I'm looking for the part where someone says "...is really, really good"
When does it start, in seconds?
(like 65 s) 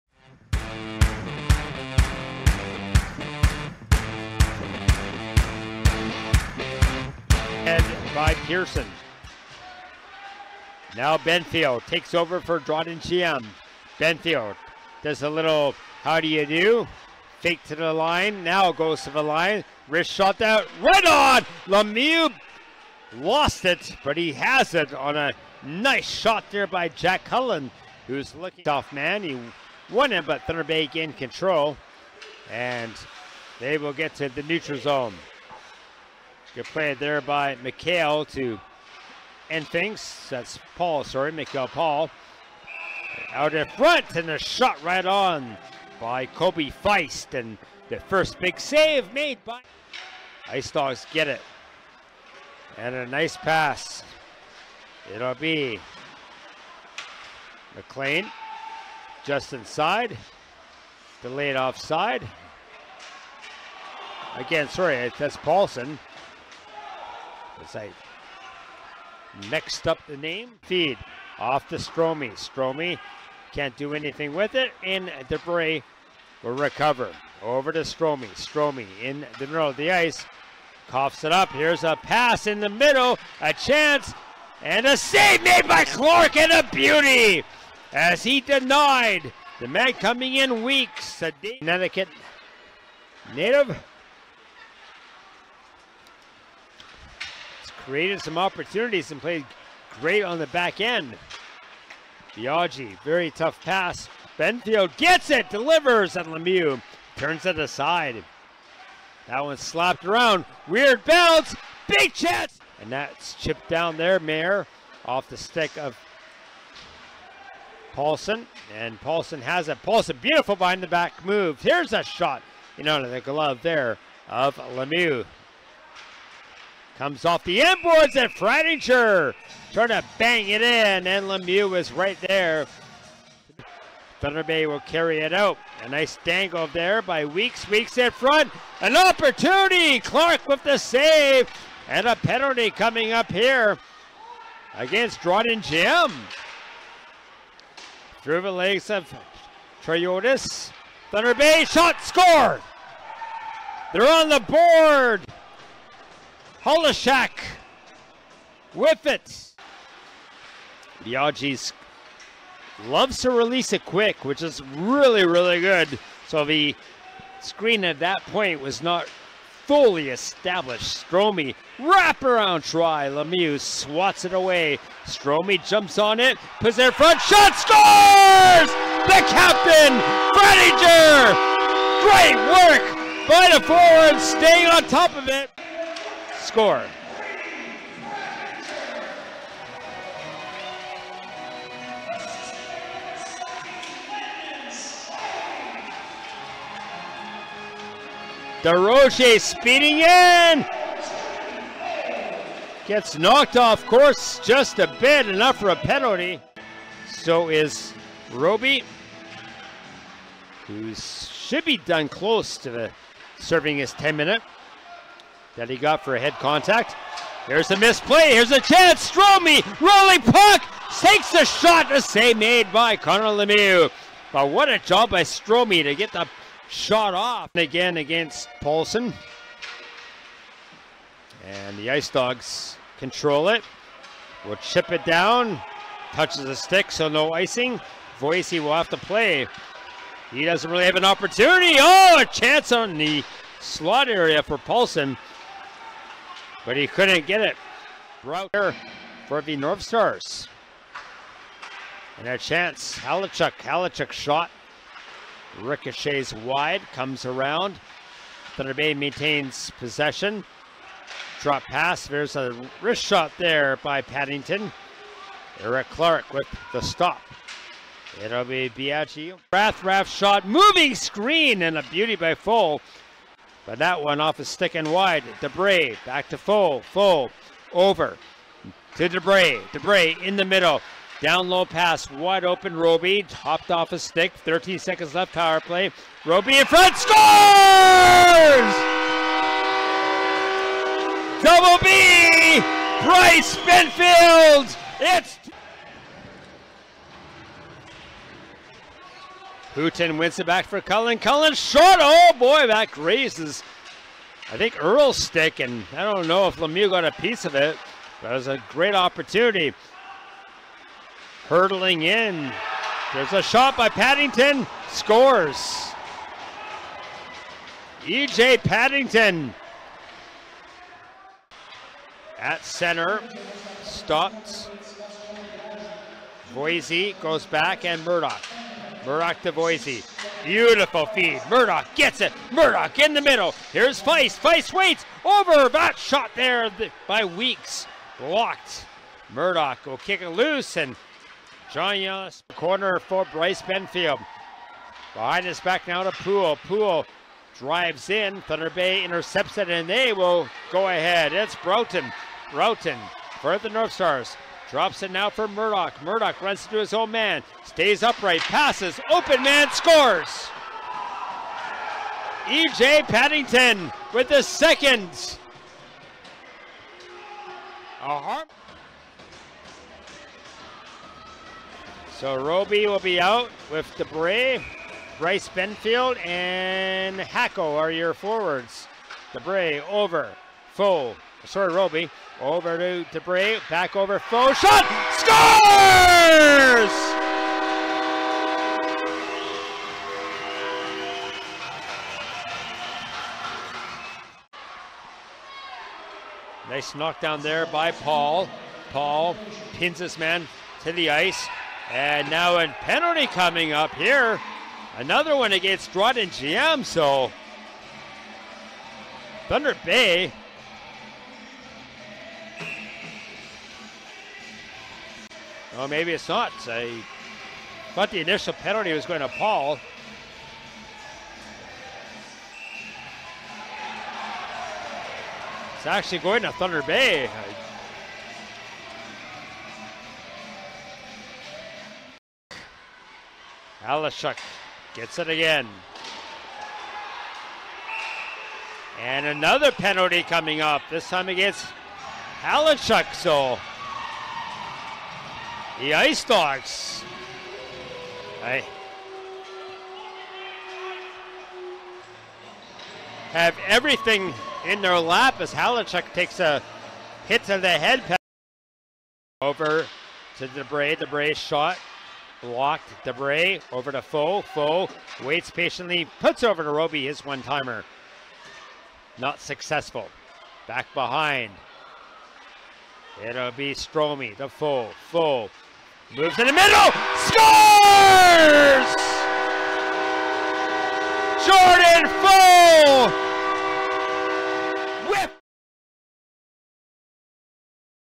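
164 s.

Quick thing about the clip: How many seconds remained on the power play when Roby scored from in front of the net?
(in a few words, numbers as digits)
13.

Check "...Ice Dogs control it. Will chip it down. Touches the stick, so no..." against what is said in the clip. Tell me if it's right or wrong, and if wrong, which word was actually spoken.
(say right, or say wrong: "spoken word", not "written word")
right.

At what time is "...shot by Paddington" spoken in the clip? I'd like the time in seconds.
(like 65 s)
313 s.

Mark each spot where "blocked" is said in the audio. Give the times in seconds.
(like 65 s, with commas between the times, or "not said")
338 s, 462 s.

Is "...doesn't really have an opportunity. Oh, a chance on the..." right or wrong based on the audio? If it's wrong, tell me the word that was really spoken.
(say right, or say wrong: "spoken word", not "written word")
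right.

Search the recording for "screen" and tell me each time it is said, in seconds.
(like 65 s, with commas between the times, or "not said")
167 s, 270 s.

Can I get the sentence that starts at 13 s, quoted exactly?
Benfield does a little how do you do?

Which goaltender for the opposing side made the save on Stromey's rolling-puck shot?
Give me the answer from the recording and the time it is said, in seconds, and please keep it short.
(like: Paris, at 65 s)
Connor Lemieux, at 222 s.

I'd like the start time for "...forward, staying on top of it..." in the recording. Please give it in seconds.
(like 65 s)
183 s.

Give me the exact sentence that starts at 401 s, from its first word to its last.
And now a penalty coming up here.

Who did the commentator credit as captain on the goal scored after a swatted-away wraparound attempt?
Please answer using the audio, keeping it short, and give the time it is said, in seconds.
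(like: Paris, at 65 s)
Frediger, at 180 s.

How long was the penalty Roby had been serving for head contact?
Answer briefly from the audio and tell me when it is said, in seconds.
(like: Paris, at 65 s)
10 minutes, at 213 s.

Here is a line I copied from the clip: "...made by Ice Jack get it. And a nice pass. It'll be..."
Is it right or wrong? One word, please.
wrong.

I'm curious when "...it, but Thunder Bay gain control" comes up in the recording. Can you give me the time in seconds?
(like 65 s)
30 s.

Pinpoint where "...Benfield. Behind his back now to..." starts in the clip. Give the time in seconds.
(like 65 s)
343 s.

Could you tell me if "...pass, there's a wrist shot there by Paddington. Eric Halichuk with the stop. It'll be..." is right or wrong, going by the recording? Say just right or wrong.
wrong.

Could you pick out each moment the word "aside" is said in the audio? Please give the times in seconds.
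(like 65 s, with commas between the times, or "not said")
107 s.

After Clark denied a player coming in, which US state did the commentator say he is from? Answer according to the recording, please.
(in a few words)
Connecticut.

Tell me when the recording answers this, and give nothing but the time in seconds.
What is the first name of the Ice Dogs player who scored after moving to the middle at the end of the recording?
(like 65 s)
481 s.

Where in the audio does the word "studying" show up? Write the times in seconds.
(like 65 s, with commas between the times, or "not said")
not said.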